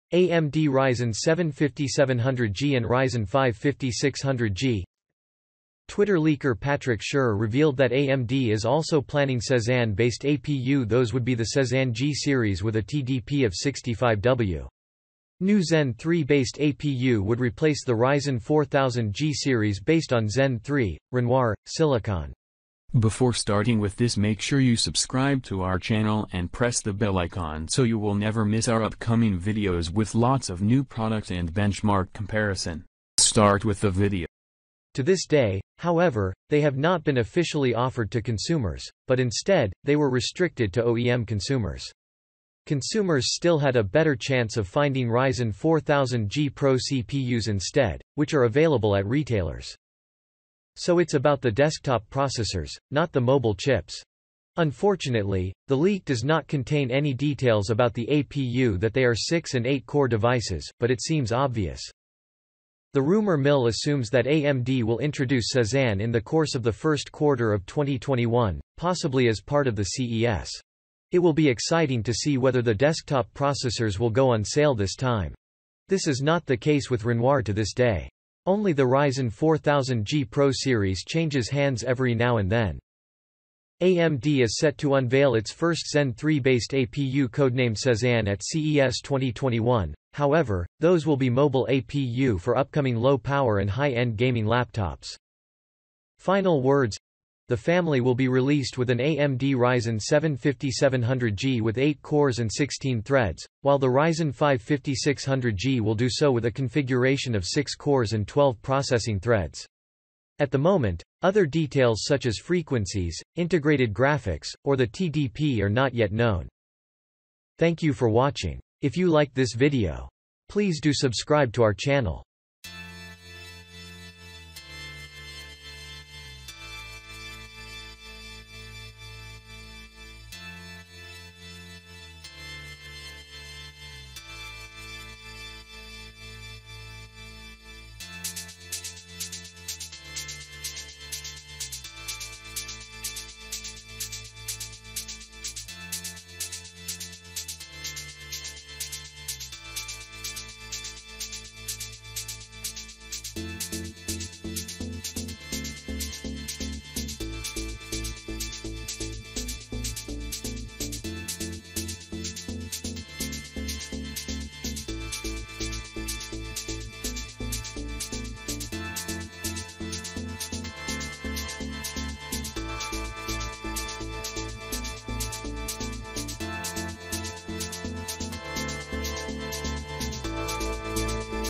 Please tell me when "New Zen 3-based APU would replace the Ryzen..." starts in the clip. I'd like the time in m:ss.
0:15.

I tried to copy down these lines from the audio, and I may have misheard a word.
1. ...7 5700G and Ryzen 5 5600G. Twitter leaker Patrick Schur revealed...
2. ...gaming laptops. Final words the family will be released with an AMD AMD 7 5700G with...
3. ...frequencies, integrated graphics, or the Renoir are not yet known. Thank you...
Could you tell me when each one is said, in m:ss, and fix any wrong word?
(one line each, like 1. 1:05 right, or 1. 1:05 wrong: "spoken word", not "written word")
1. 0:01 right
2. 1:34 wrong: "Ryzen", not "AMD"
3. 1:52 wrong: "TDP", not "Renoir".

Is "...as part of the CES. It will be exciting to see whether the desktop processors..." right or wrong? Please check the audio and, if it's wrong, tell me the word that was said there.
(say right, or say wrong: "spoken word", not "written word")
right.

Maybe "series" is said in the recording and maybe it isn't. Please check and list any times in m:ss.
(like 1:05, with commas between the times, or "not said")
0:12, 0:19, 1:20.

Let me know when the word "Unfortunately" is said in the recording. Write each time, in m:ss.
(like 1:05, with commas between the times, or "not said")
0:54.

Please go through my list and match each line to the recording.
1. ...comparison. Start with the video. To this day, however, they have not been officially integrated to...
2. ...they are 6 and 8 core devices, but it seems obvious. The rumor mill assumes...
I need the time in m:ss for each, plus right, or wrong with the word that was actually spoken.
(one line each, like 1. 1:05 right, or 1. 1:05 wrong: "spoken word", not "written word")
1. 0:32 wrong: "offered", not "integrated"
2. 0:58 right.